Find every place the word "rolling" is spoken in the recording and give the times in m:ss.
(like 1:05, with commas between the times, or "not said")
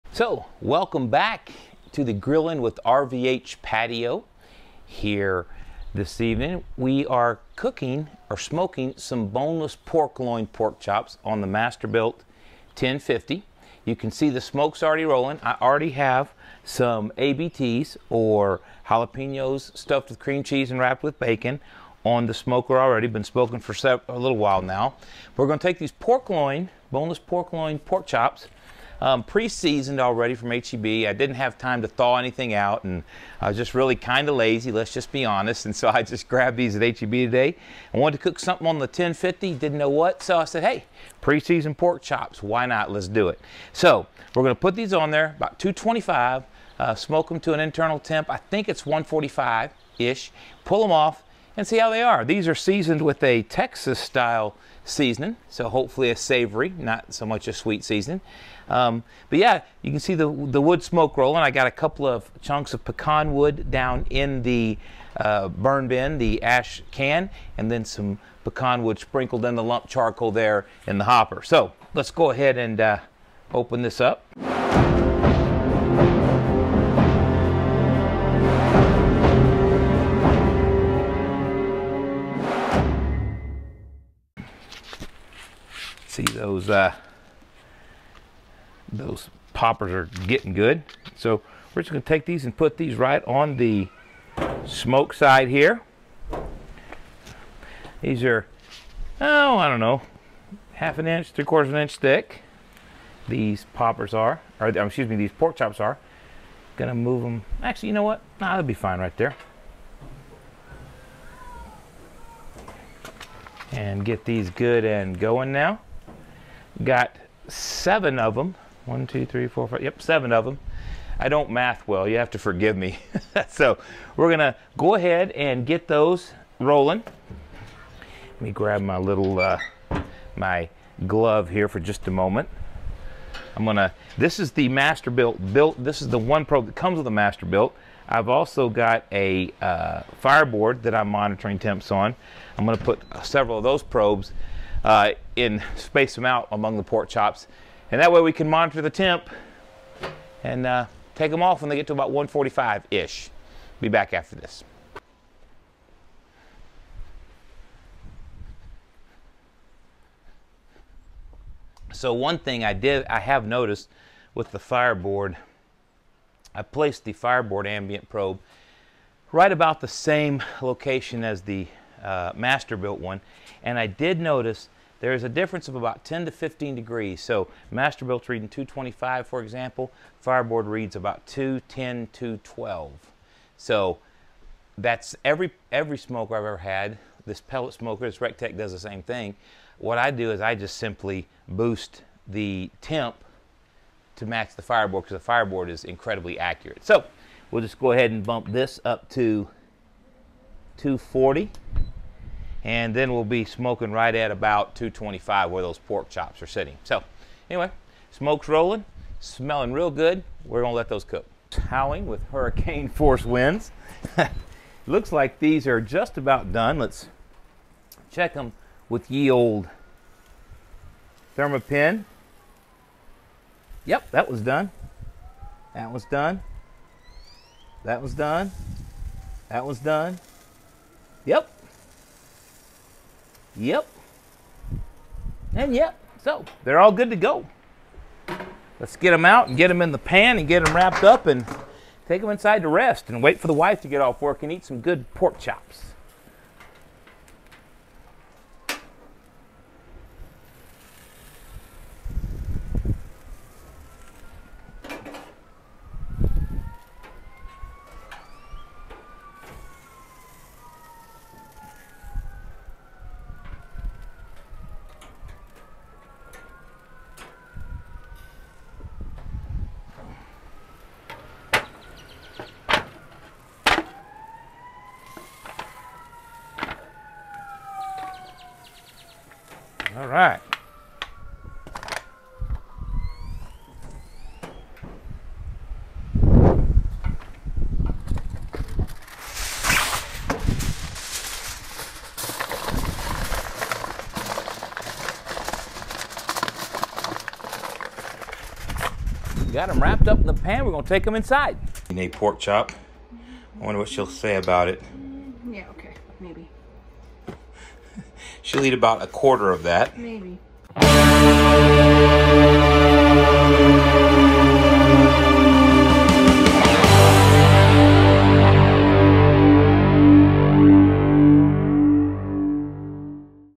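0:15, 1:01, 2:06, 3:28.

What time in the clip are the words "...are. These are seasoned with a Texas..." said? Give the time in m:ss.
0:52.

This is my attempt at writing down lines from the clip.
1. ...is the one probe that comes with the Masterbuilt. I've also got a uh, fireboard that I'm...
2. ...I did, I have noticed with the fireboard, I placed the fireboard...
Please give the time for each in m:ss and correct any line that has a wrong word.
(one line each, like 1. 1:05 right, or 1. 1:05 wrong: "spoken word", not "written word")
1. 2:16 right
2. 2:42 right.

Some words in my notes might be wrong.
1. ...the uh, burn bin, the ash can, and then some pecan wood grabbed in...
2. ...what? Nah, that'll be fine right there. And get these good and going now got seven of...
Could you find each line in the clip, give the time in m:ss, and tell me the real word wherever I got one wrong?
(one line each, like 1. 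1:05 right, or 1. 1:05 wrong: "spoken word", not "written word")
1. 1:04 wrong: "sprinkled", not "grabbed"
2. 1:48 right.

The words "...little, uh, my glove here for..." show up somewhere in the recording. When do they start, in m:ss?
2:08.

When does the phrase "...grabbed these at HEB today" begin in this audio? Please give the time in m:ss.
0:36.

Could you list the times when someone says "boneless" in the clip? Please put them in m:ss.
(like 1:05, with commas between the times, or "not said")
0:09, 0:26.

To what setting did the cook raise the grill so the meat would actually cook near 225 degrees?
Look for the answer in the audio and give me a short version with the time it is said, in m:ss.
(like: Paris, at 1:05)
240, at 3:20.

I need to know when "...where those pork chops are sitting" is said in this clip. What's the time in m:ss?
3:25.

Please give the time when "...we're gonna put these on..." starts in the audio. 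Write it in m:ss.
0:44.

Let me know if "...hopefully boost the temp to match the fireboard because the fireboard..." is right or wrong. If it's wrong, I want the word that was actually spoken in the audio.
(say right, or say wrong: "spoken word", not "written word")
wrong: "simply", not "hopefully".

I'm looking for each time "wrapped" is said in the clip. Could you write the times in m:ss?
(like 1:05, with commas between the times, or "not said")
0:20, 4:00, 4:59.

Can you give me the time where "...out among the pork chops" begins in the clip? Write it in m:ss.
2:26.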